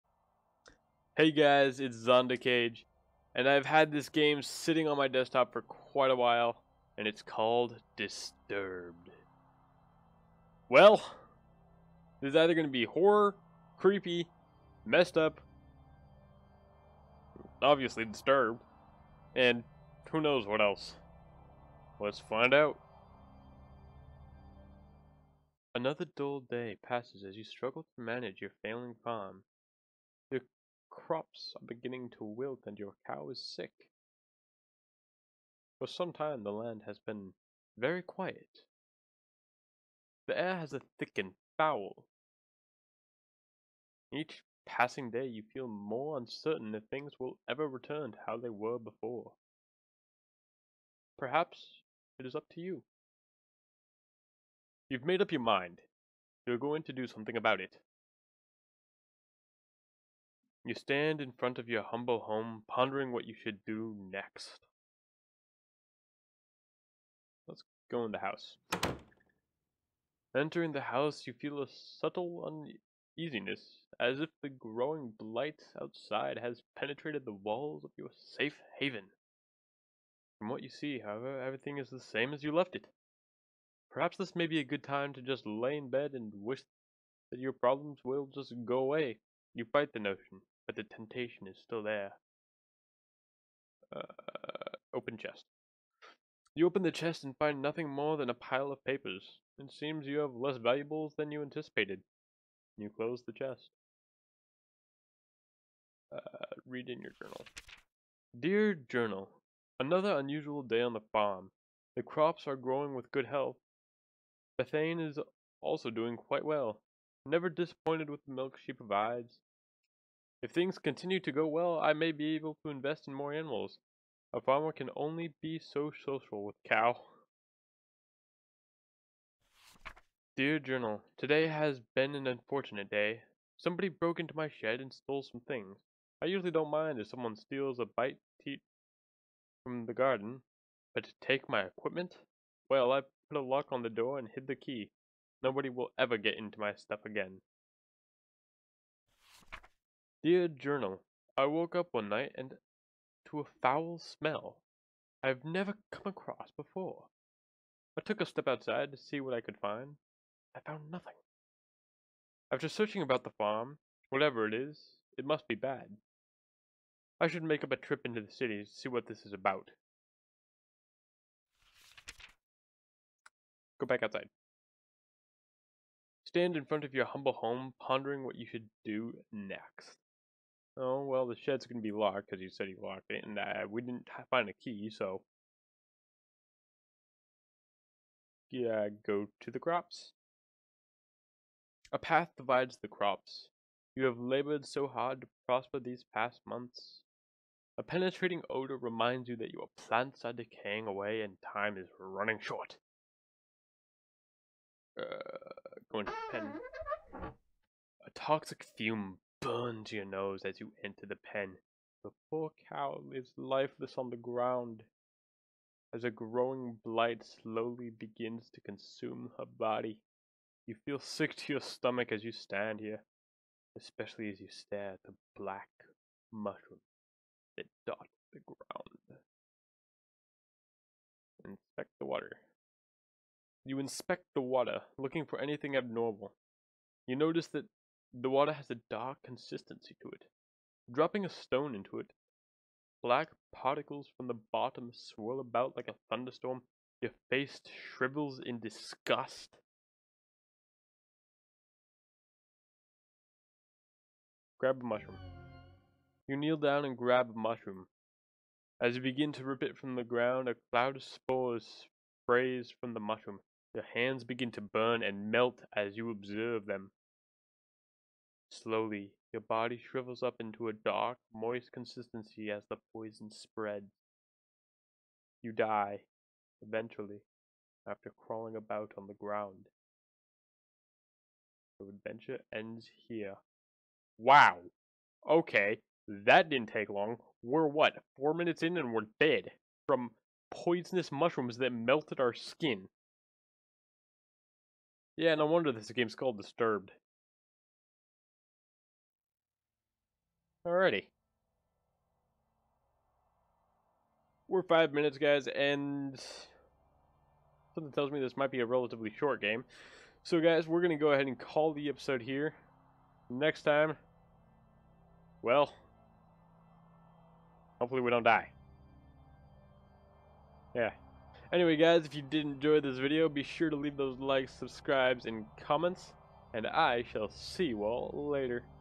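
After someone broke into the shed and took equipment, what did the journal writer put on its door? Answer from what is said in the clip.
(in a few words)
a lock.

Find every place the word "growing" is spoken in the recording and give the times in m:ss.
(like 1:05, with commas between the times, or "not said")
1:14, 1:52, 3:36.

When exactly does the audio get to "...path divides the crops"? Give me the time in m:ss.
3:11.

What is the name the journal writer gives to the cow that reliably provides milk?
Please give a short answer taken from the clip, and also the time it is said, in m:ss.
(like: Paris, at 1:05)
Bethane, at 1:54.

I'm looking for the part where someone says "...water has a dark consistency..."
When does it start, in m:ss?
3:58.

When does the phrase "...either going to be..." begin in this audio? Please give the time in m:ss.
0:12.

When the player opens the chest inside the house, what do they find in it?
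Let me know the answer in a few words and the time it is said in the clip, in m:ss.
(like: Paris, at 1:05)
a pile of papers, at 1:38.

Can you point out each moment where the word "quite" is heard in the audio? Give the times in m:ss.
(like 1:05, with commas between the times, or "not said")
0:05, 1:56.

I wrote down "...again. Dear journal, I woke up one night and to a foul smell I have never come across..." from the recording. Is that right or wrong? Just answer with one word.
right.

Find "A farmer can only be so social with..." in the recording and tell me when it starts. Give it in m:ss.
2:04.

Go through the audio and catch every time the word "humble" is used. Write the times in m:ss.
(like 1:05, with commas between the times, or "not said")
1:01, 2:57.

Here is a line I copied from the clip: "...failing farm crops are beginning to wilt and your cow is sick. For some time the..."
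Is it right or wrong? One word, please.
right.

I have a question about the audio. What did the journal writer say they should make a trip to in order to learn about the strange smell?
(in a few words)
the city.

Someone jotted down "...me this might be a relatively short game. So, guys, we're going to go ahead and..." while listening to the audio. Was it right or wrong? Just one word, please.
right.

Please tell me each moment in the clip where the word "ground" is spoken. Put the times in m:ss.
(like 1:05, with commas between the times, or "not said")
3:34, 3:48, 4:20, 4:39.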